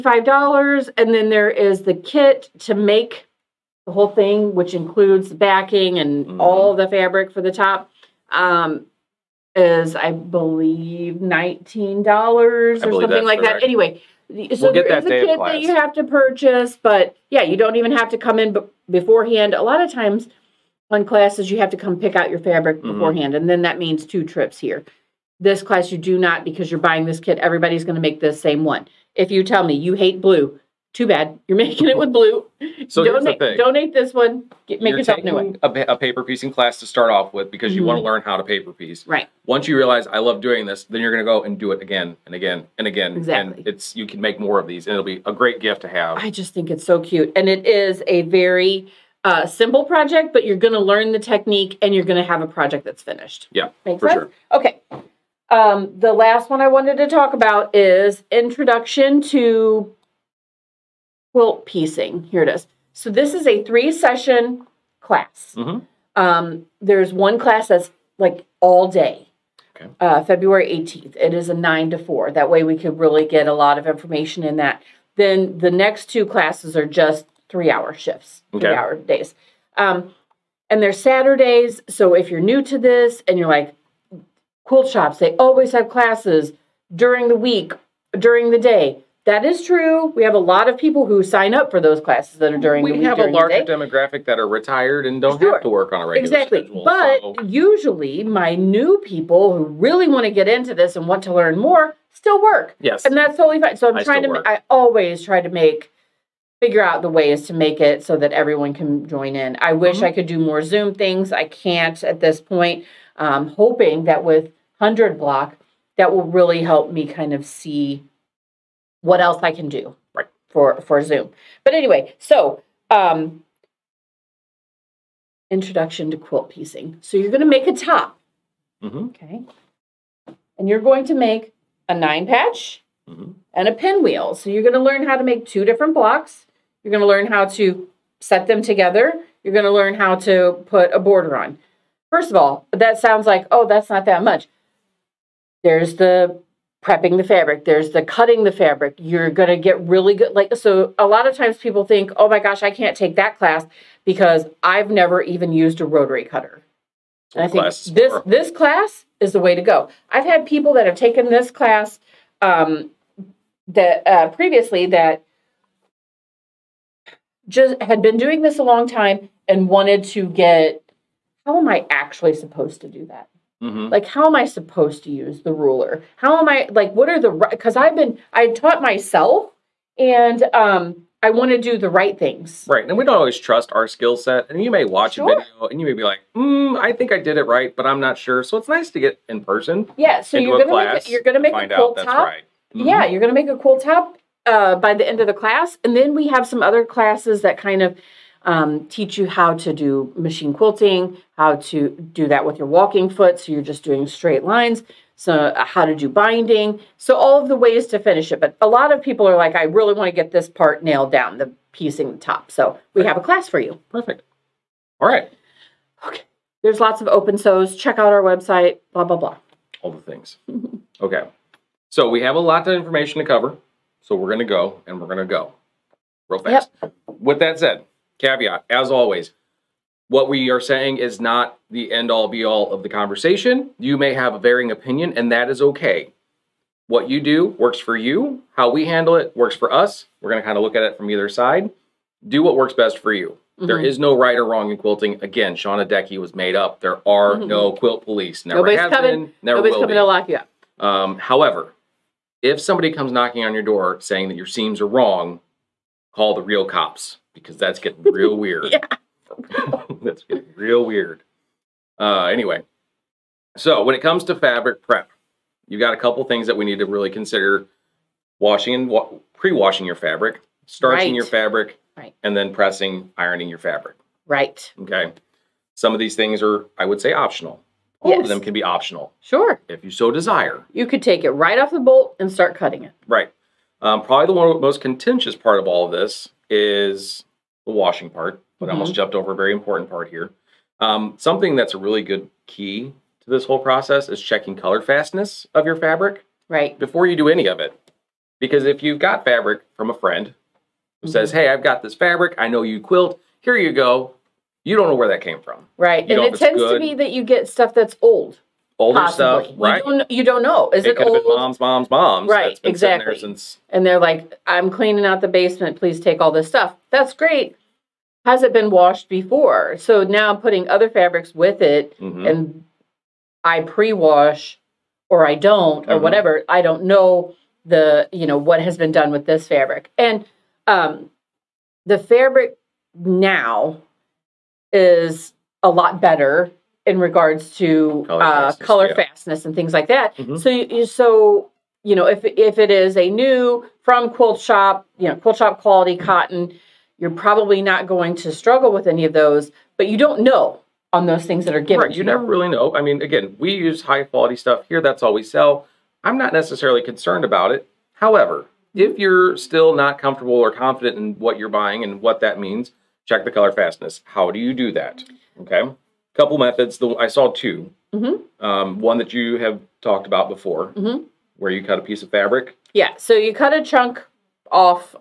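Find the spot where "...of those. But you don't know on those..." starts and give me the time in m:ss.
5:49.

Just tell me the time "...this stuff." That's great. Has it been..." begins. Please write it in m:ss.
5:16.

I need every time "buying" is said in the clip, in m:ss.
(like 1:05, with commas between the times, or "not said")
0:26, 6:01.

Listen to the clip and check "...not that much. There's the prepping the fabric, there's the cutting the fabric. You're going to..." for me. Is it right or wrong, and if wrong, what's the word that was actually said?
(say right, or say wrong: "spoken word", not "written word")
right.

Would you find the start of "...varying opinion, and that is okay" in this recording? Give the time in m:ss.
3:54.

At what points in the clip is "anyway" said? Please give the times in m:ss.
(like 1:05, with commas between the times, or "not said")
0:13, 2:01, 4:22.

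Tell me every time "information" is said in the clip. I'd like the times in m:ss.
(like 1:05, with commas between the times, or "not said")
1:13, 3:42.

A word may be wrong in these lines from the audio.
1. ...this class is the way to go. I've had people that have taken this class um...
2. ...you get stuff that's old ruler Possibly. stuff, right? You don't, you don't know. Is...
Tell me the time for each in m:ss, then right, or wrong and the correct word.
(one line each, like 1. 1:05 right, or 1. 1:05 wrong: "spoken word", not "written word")
1. 2:38 right
2. 5:07 wrong: "older", not "ruler".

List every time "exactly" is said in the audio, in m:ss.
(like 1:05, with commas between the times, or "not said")
0:43, 1:36, 5:12.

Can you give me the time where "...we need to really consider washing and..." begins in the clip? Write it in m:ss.
4:26.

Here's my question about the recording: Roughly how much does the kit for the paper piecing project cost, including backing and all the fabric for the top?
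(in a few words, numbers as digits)
$19.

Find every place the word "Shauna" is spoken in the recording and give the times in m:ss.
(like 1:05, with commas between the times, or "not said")
4:05.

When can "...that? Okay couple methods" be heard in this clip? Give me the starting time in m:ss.
6:04.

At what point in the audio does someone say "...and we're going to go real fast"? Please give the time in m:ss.
3:44.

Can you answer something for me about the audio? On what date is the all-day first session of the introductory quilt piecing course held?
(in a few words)
February 18th.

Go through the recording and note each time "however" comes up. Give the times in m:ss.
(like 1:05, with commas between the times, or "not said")
4:11, 5:57.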